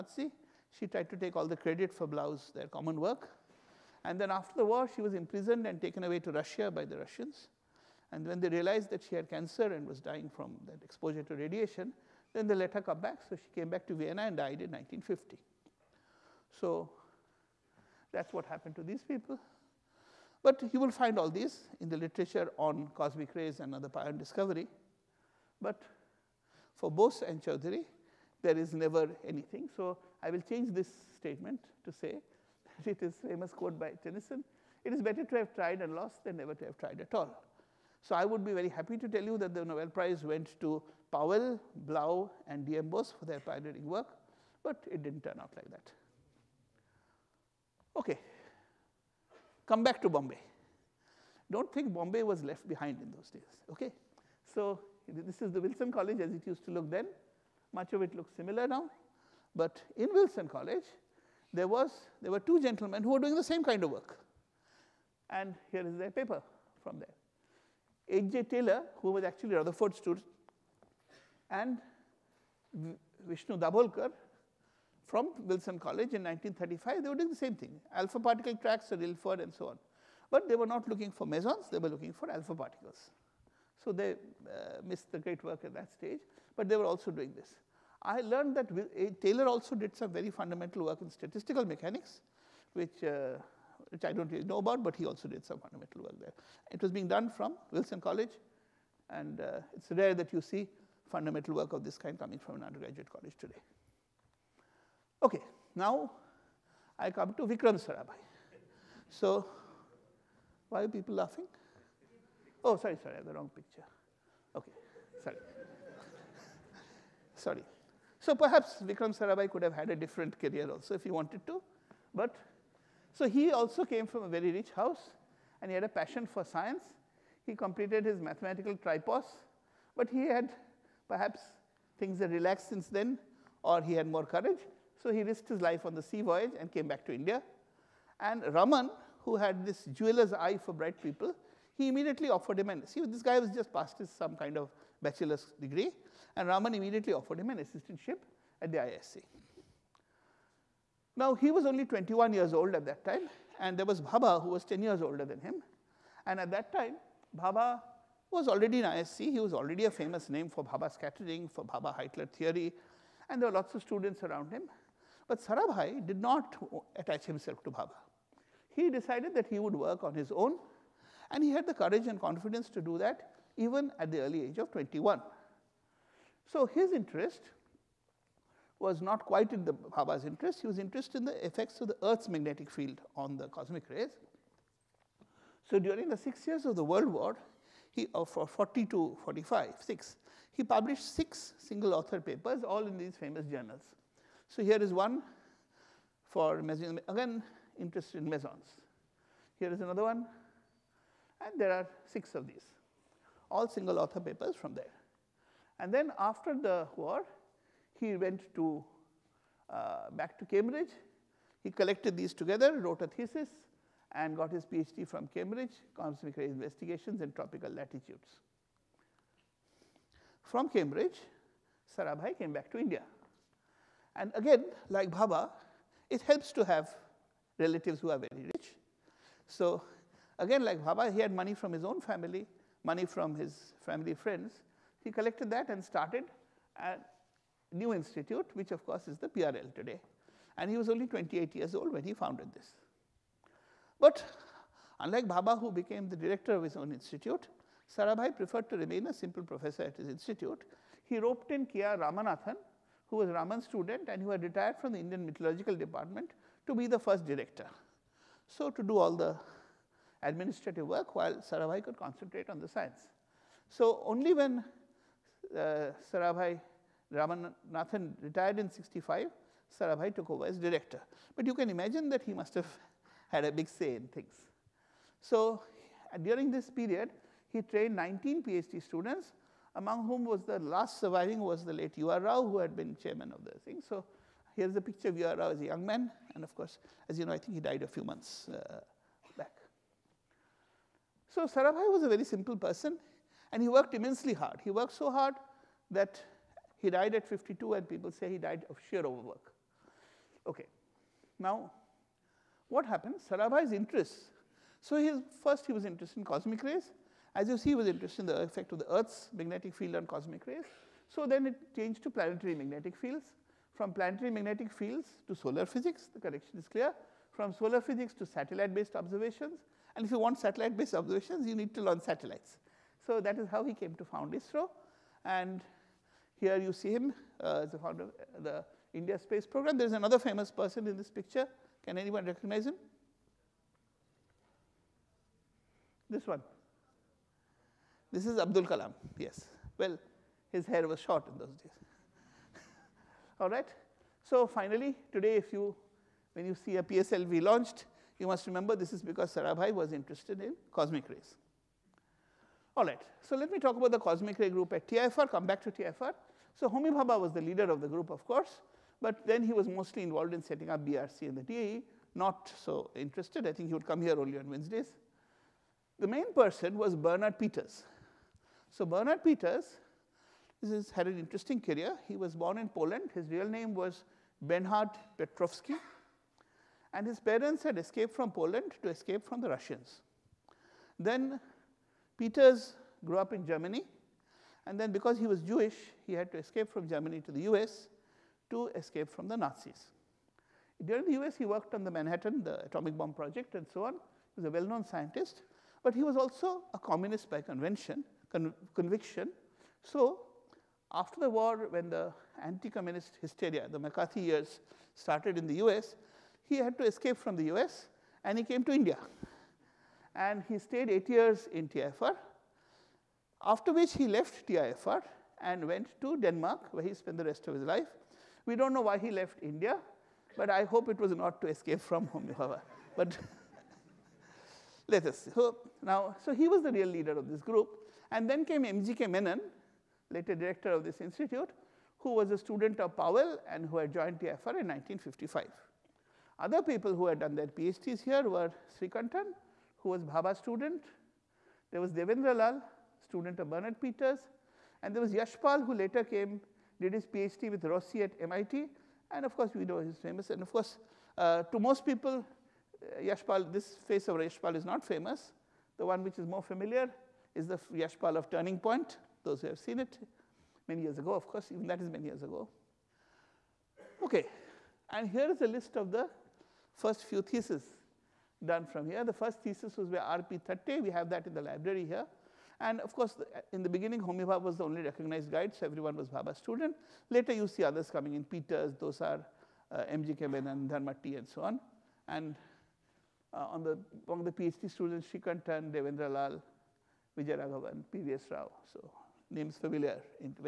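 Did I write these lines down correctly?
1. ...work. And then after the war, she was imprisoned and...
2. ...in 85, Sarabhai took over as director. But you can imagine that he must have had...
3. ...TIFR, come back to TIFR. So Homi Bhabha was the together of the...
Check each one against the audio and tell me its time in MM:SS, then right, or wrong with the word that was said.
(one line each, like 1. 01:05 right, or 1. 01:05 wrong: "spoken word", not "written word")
1. 00:02 right
2. 04:28 wrong: "65", not "85"
3. 05:54 wrong: "leader", not "together".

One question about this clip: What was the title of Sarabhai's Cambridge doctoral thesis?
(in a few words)
Cosmic Ray Investigations in Tropical Latitudes.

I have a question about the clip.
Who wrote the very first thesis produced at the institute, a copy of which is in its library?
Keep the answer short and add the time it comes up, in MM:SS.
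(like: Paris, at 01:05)
R.P. Thatte, at 07:49.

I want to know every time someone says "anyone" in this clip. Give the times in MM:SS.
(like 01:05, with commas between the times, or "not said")
05:31.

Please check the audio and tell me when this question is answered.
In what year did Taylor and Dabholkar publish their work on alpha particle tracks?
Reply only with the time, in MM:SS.
01:16.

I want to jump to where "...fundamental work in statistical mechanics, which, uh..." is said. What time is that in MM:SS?
01:30.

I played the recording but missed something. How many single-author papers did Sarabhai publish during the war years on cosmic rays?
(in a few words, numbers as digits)
6.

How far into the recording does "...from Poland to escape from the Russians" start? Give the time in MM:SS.
06:18.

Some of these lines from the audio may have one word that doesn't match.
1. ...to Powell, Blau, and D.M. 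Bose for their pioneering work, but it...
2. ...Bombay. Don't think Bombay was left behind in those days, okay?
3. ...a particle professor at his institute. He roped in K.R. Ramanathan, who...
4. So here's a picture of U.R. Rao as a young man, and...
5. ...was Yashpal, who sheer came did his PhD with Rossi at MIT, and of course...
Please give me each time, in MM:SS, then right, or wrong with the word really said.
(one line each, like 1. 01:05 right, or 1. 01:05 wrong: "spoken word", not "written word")
1. 00:40 right
2. 00:50 right
3. 04:09 wrong: "simple", not "particle"
4. 04:43 right
5. 07:24 wrong: "later", not "sheer".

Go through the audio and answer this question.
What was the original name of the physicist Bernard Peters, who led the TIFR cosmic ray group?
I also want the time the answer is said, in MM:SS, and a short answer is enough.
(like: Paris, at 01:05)
Bernhard Petrovsky, at 06:14.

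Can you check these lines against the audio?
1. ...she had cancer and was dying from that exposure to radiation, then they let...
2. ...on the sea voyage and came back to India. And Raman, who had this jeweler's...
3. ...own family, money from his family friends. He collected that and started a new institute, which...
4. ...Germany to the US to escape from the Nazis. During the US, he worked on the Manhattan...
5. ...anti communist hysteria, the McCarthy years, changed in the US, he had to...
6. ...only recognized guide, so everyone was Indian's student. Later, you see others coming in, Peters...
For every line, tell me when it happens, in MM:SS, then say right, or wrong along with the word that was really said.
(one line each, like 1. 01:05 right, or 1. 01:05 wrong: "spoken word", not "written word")
1. 00:09 right
2. 02:15 right
3. 03:51 right
4. 06:26 right
5. 06:42 wrong: "started", not "changed"
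6. 07:54 wrong: "Bhabha", not "Indian".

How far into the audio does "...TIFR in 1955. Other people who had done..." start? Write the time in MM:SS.
07:14.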